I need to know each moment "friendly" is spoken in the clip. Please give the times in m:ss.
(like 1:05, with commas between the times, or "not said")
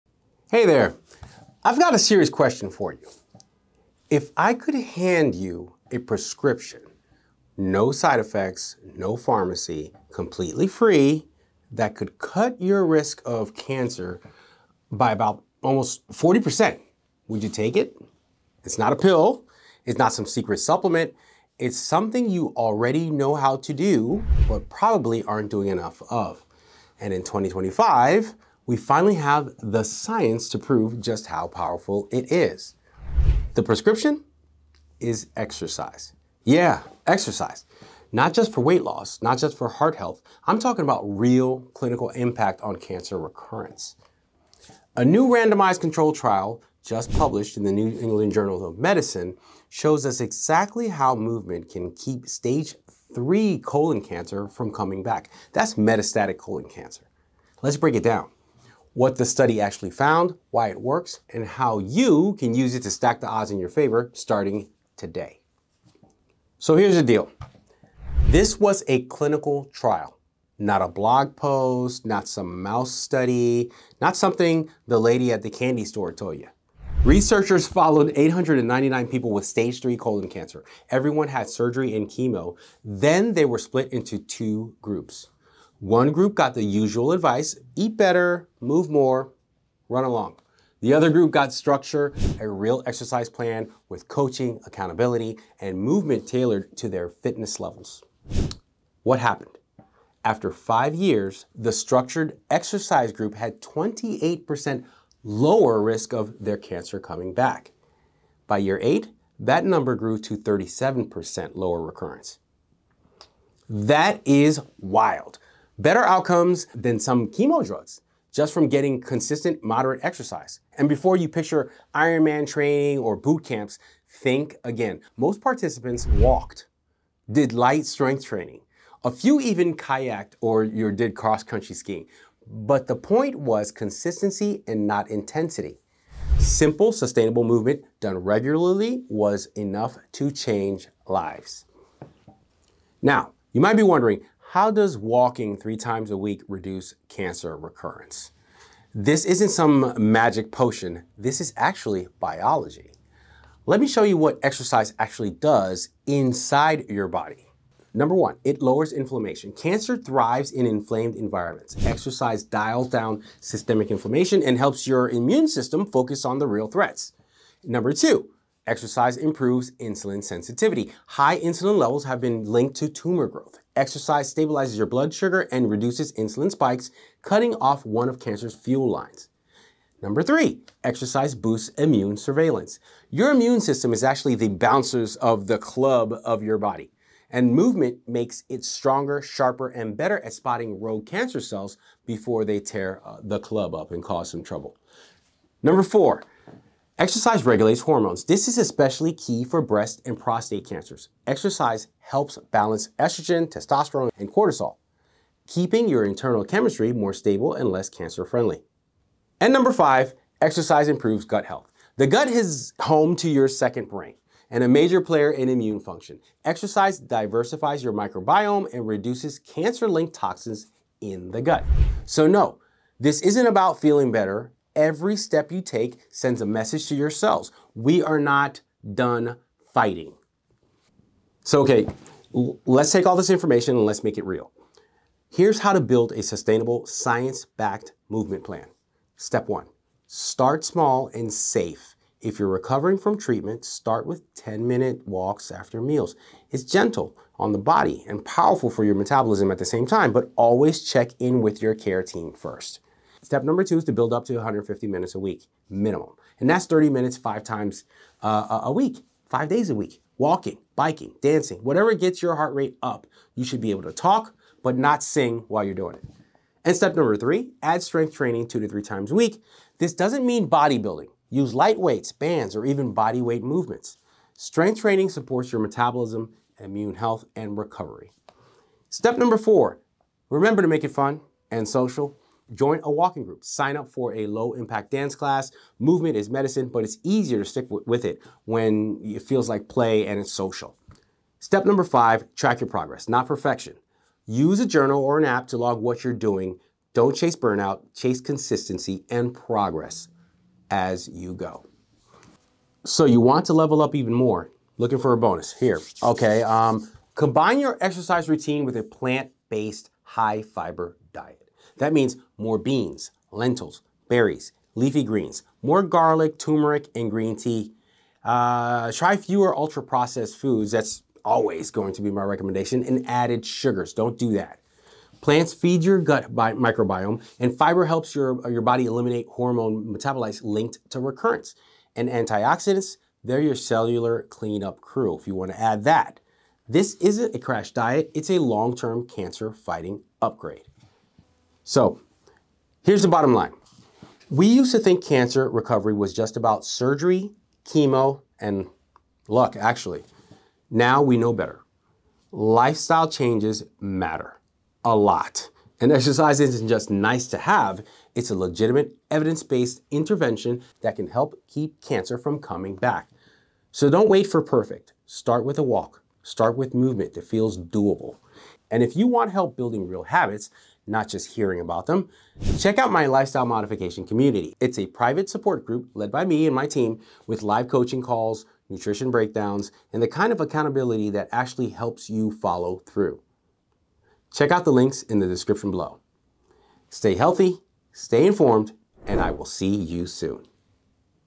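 3:28.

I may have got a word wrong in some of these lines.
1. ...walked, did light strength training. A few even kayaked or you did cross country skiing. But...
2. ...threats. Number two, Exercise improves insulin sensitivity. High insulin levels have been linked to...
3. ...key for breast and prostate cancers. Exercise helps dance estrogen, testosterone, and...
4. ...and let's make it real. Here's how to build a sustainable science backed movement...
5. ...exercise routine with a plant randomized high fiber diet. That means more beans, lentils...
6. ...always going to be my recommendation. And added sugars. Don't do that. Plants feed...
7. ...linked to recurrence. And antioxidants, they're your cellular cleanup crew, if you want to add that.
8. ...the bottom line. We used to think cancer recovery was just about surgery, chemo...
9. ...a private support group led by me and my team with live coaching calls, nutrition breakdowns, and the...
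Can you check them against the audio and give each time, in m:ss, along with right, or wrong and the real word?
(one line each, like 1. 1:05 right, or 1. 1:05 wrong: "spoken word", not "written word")
1. 2:06 right
2. 2:46 right
3. 3:19 wrong: "balance", not "dance"
4. 3:53 right
5. 5:07 wrong: "based", not "randomized"
6. 5:21 right
7. 5:30 right
8. 5:43 right
9. 6:14 right.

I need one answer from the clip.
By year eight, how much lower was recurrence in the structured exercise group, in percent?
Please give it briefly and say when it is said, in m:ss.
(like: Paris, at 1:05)
37%, at 1:50.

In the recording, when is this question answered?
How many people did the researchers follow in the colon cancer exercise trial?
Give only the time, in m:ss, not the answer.
1:18.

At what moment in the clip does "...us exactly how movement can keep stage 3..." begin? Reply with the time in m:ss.
0:50.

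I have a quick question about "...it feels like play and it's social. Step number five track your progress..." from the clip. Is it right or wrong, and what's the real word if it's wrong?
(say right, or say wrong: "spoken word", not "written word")
right.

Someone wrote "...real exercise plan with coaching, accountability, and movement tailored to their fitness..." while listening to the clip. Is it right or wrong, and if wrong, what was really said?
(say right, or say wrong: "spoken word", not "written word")
right.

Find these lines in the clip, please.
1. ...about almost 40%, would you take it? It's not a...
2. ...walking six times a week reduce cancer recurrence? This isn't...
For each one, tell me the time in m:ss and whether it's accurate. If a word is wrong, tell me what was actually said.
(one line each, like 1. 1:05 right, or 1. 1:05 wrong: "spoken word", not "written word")
1. 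0:15 right
2. 2:24 wrong: "three", not "six".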